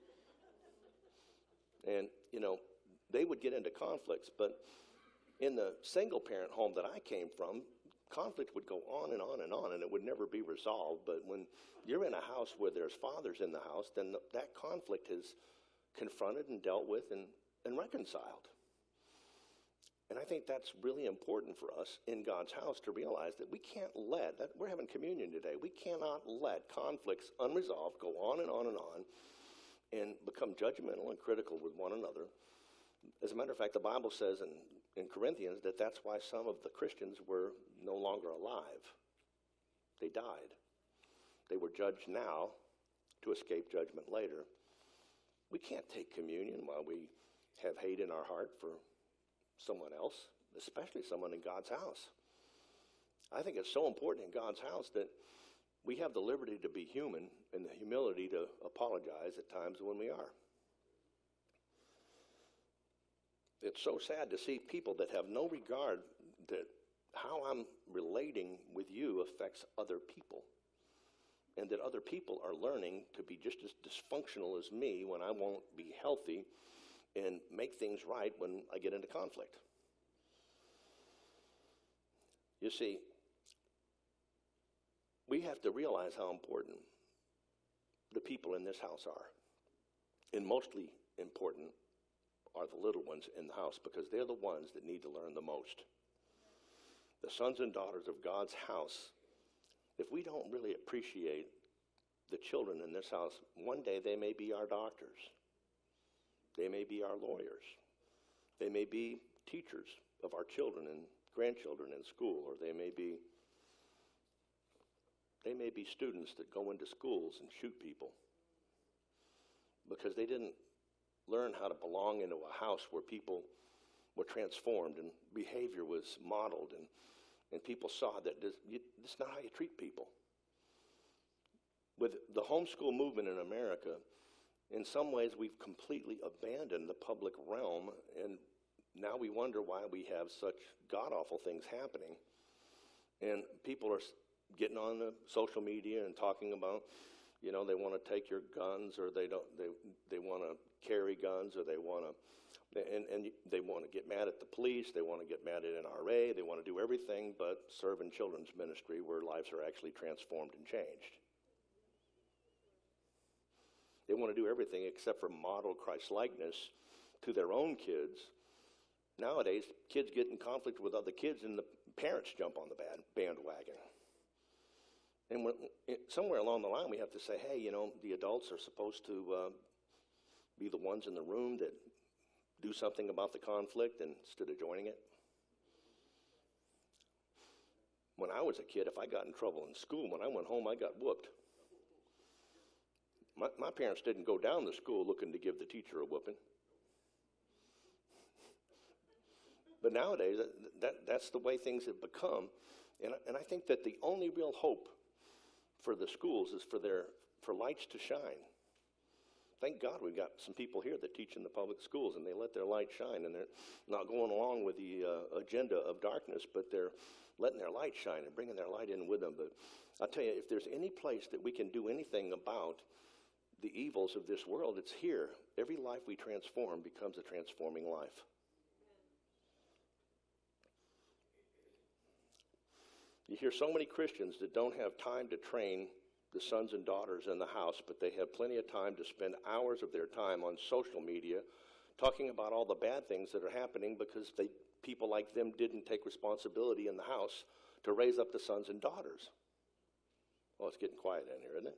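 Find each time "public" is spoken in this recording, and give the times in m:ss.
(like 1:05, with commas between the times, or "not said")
2:16, 3:31.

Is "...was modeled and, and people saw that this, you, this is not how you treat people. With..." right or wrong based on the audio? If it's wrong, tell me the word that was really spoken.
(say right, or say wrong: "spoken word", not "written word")
right.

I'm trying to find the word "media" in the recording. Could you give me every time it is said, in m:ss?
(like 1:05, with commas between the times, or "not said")
2:25, 4:01.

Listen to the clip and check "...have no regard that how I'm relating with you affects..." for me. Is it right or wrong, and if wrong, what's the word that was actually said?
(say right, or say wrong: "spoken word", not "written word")
right.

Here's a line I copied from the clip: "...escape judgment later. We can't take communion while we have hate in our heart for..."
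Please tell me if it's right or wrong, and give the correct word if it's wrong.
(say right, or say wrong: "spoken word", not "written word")
right.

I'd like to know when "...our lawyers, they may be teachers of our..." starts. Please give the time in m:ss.
1:47.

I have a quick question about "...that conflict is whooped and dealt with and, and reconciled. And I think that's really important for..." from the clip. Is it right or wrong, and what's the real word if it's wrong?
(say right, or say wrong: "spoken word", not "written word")
wrong: "confronted", not "whooped".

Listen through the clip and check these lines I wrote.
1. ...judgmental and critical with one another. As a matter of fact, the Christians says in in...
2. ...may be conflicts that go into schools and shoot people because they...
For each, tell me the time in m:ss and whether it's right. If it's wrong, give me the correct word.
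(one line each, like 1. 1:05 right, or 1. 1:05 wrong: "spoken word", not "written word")
1. 0:30 wrong: "Bible", not "Christians"
2. 1:55 wrong: "students", not "conflicts".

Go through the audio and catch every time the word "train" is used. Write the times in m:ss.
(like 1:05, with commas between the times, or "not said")
3:55.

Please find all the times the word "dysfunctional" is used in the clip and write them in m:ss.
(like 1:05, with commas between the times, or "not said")
1:13.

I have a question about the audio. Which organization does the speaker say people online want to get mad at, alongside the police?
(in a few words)
NRA.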